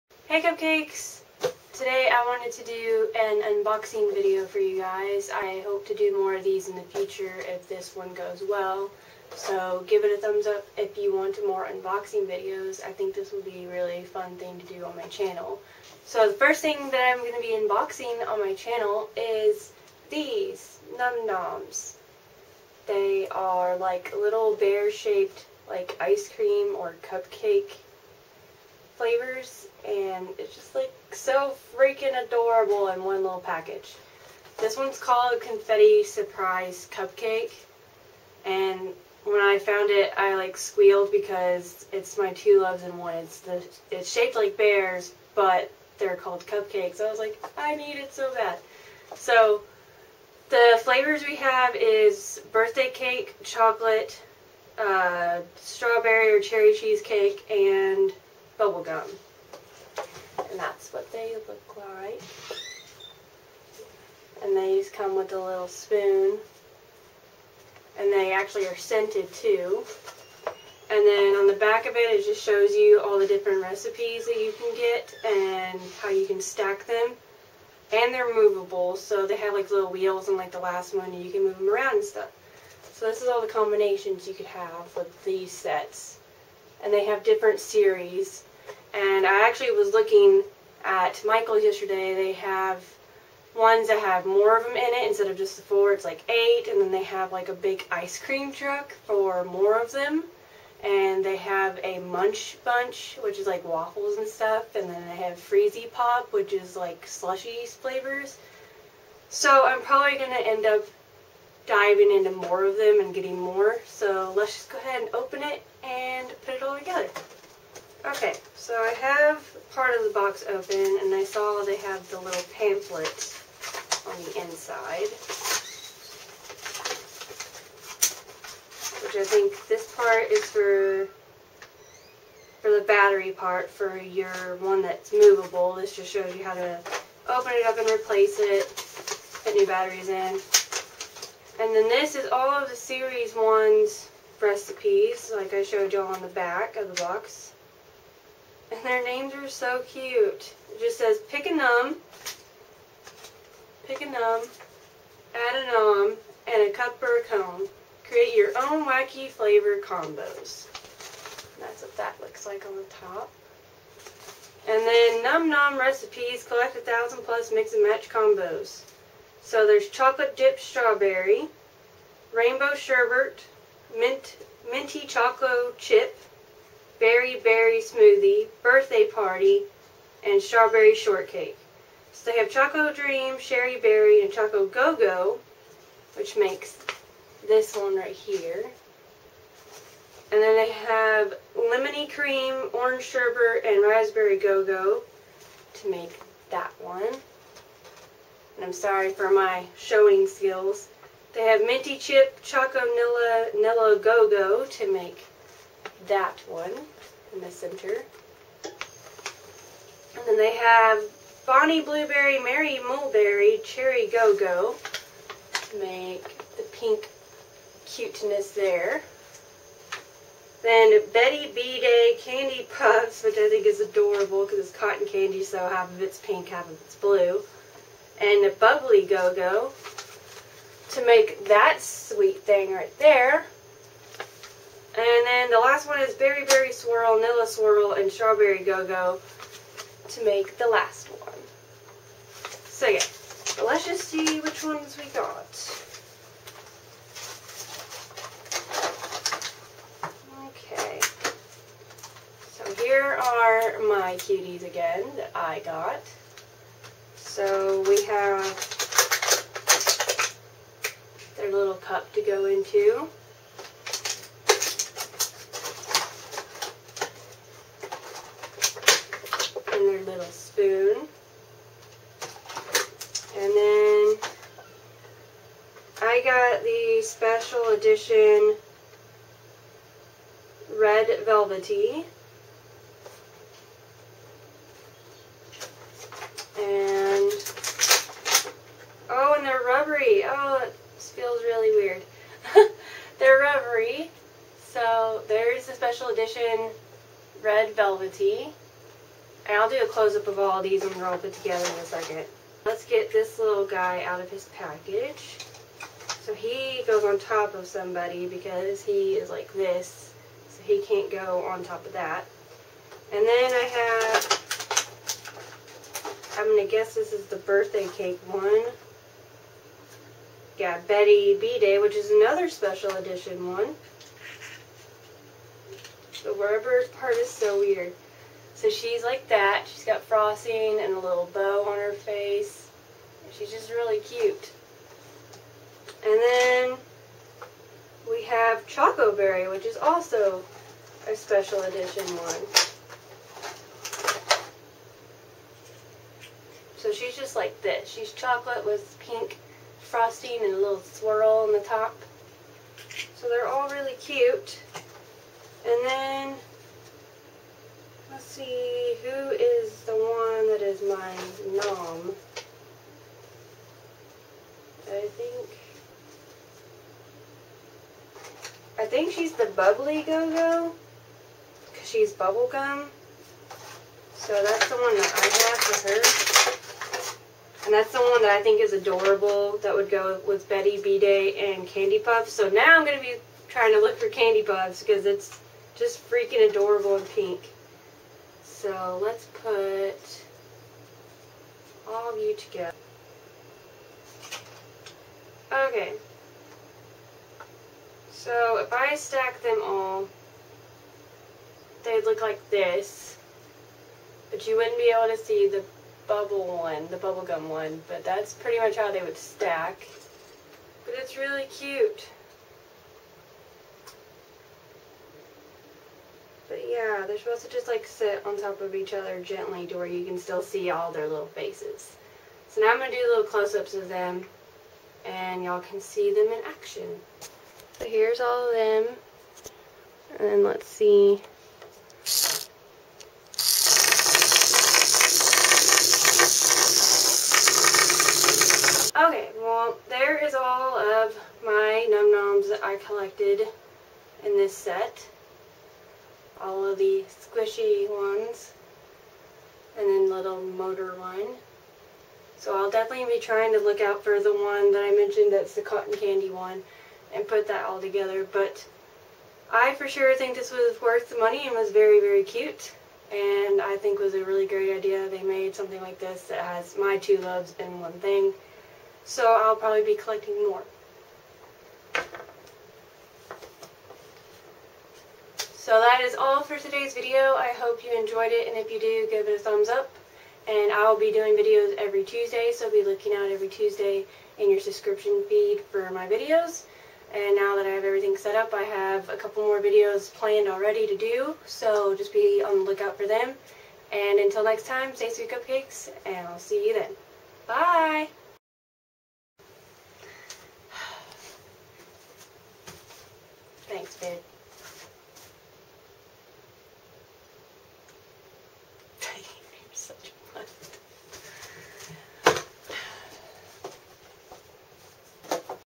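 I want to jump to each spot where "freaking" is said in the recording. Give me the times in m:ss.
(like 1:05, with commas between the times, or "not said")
0:31, 6:26.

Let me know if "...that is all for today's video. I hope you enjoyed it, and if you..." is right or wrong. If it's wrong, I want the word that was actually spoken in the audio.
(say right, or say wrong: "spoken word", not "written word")
right.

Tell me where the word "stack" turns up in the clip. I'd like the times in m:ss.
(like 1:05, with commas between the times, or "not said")
1:16, 6:38, 6:49.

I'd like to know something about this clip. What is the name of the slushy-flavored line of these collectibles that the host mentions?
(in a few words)
Freezy Pop.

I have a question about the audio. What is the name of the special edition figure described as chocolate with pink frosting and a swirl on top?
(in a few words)
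Choco Berry.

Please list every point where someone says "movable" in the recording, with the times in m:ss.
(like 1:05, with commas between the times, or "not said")
1:18, 2:15.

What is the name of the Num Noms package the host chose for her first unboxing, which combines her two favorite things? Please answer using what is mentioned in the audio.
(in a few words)
Confetti Surprise Cupcake.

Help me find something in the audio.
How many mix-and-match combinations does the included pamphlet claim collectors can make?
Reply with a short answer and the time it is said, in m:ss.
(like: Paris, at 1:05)
1000 plus, at 2:46.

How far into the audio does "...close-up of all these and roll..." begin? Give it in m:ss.
4:59.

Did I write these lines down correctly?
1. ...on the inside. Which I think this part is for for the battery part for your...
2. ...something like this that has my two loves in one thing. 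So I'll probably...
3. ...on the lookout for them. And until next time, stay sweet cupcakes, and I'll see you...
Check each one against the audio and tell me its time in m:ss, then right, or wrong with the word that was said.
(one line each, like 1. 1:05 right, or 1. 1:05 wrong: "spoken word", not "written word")
1. 2:04 right
2. 7:45 right
3. 8:12 right.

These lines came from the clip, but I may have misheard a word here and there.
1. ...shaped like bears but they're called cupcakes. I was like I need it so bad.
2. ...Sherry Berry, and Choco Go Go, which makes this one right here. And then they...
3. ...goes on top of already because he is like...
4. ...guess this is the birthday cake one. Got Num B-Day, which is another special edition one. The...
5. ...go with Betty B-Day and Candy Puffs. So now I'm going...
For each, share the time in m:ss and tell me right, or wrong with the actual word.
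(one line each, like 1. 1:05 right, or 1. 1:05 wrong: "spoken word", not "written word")
1. 0:44 right
2. 3:03 right
3. 5:06 wrong: "somebody", not "already"
4. 5:16 wrong: "Betty", not "Num"
5. 6:19 right.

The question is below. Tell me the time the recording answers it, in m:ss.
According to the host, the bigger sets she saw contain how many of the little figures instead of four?
1:36.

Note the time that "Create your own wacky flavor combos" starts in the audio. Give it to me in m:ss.
2:38.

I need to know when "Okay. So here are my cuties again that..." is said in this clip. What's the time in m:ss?
4:10.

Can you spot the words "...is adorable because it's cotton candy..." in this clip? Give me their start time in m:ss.
3:43.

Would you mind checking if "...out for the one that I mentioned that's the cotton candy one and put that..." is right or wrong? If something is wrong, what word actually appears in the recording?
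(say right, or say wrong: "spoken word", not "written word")
right.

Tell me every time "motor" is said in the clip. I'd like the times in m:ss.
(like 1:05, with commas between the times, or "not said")
7:30.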